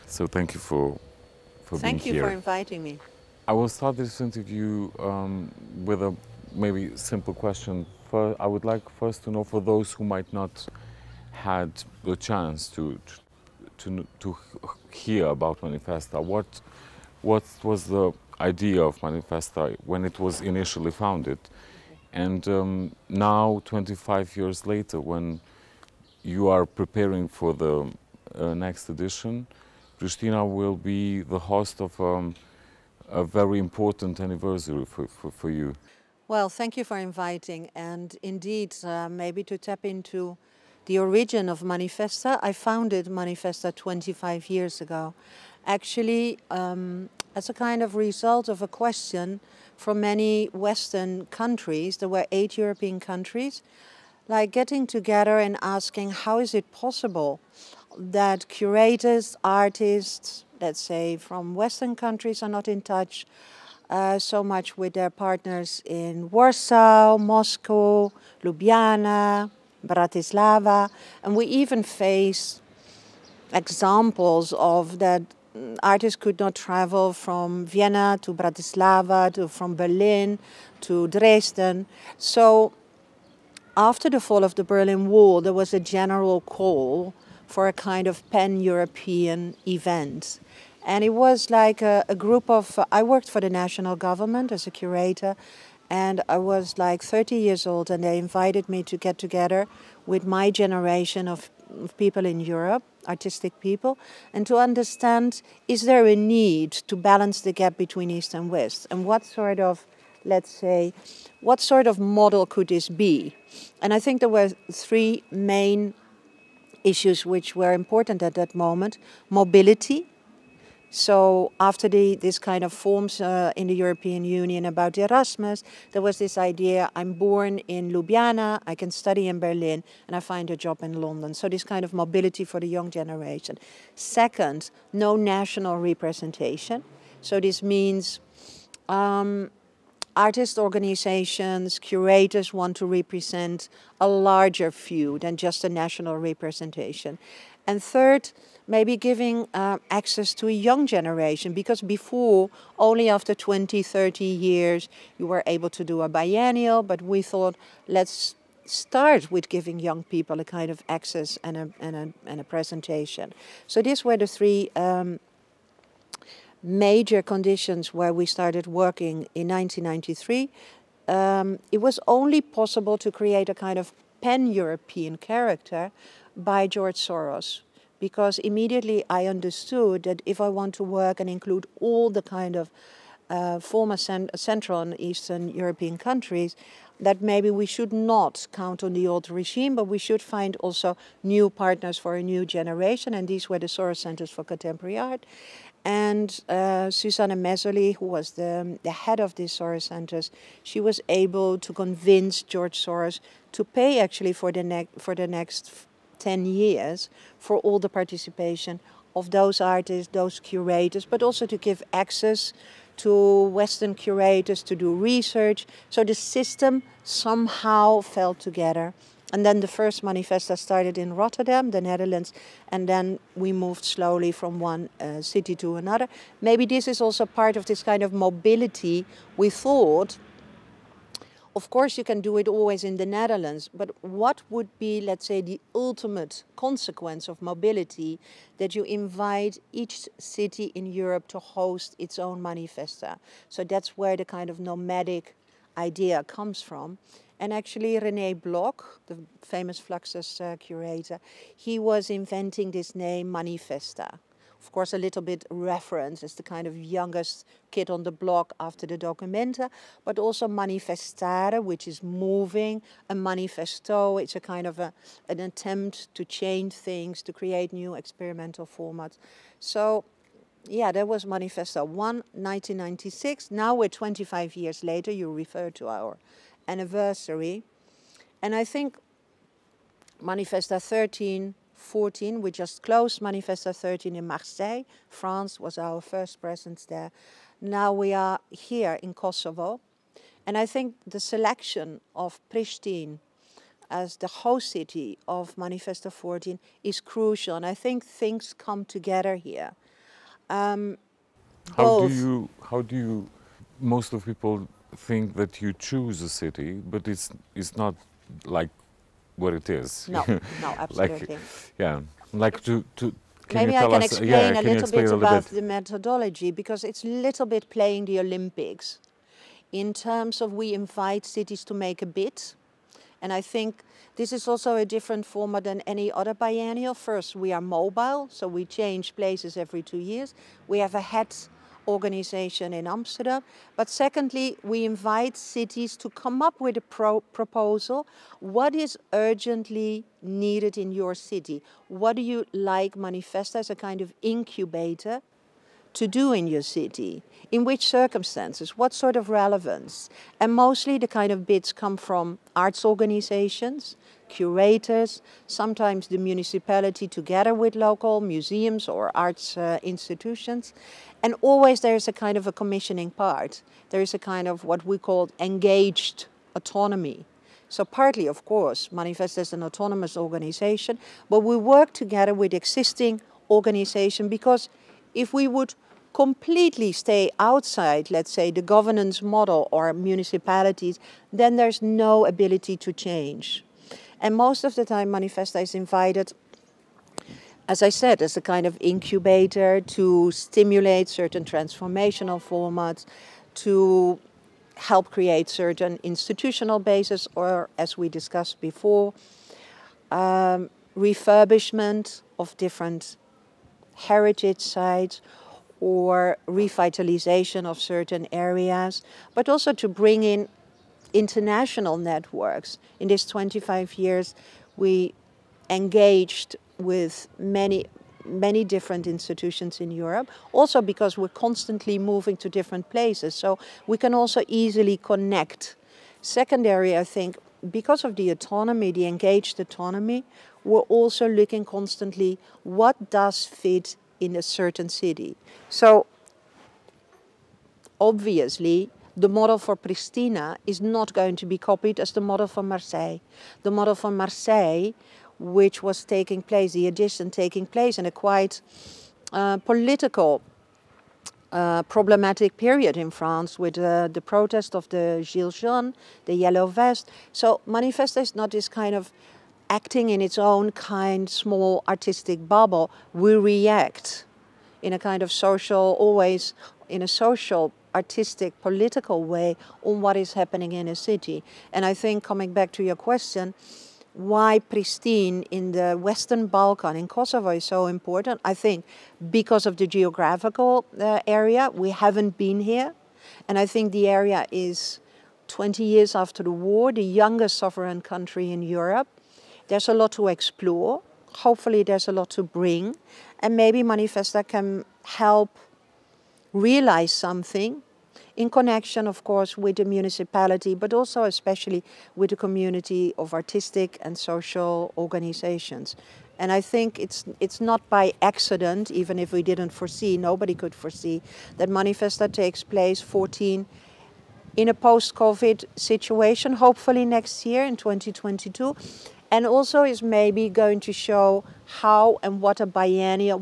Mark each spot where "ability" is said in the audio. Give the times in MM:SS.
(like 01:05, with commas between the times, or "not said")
06:22.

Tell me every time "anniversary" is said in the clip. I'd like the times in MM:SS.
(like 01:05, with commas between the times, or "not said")
00:34, 04:36.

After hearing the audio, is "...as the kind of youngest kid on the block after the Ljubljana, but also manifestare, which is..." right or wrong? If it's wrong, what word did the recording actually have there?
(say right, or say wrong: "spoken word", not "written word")
wrong: "Documenta", not "Ljubljana".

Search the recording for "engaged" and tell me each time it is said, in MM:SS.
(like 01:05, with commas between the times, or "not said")
06:05, 06:55, 07:09.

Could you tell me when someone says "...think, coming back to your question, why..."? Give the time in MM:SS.
07:51.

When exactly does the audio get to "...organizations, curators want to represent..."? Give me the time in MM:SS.
02:20.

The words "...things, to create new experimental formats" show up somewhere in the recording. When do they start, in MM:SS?
04:26.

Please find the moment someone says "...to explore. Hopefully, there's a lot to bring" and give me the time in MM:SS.
08:10.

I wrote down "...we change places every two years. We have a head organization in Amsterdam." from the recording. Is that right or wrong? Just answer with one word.
right.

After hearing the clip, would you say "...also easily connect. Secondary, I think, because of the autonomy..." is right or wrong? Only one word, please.
right.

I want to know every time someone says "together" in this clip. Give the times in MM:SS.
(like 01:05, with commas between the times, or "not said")
00:54, 01:39, 03:38, 04:58, 05:57, 06:11.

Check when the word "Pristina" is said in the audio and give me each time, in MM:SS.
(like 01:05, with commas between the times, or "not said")
00:29, 04:52, 07:19, 07:54.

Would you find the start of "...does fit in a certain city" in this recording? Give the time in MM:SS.
07:13.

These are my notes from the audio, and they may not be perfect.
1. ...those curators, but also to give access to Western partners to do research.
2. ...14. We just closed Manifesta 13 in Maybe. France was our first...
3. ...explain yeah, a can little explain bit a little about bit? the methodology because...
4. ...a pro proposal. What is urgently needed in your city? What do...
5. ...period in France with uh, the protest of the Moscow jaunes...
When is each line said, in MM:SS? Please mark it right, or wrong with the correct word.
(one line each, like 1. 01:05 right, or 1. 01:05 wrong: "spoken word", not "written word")
1. 03:30 wrong: "curators", not "partners"
2. 04:41 wrong: "Marseille", not "Maybe"
3. 05:14 right
4. 05:36 right
5. 07:32 wrong: "Gilets", not "Moscow".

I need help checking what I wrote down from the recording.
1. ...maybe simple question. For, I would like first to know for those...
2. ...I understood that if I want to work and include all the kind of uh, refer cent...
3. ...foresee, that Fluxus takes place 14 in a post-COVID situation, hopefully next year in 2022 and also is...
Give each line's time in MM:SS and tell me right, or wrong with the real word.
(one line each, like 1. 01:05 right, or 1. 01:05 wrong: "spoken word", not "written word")
1. 00:06 right
2. 02:59 wrong: "former", not "refer"
3. 08:30 wrong: "Manifesta", not "Fluxus".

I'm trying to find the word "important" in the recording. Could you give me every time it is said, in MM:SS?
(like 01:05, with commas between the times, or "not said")
00:33, 01:57, 07:57.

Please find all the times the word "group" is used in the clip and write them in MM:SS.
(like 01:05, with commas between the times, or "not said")
01:32.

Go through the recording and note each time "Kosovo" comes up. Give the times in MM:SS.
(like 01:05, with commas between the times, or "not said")
04:49, 07:57.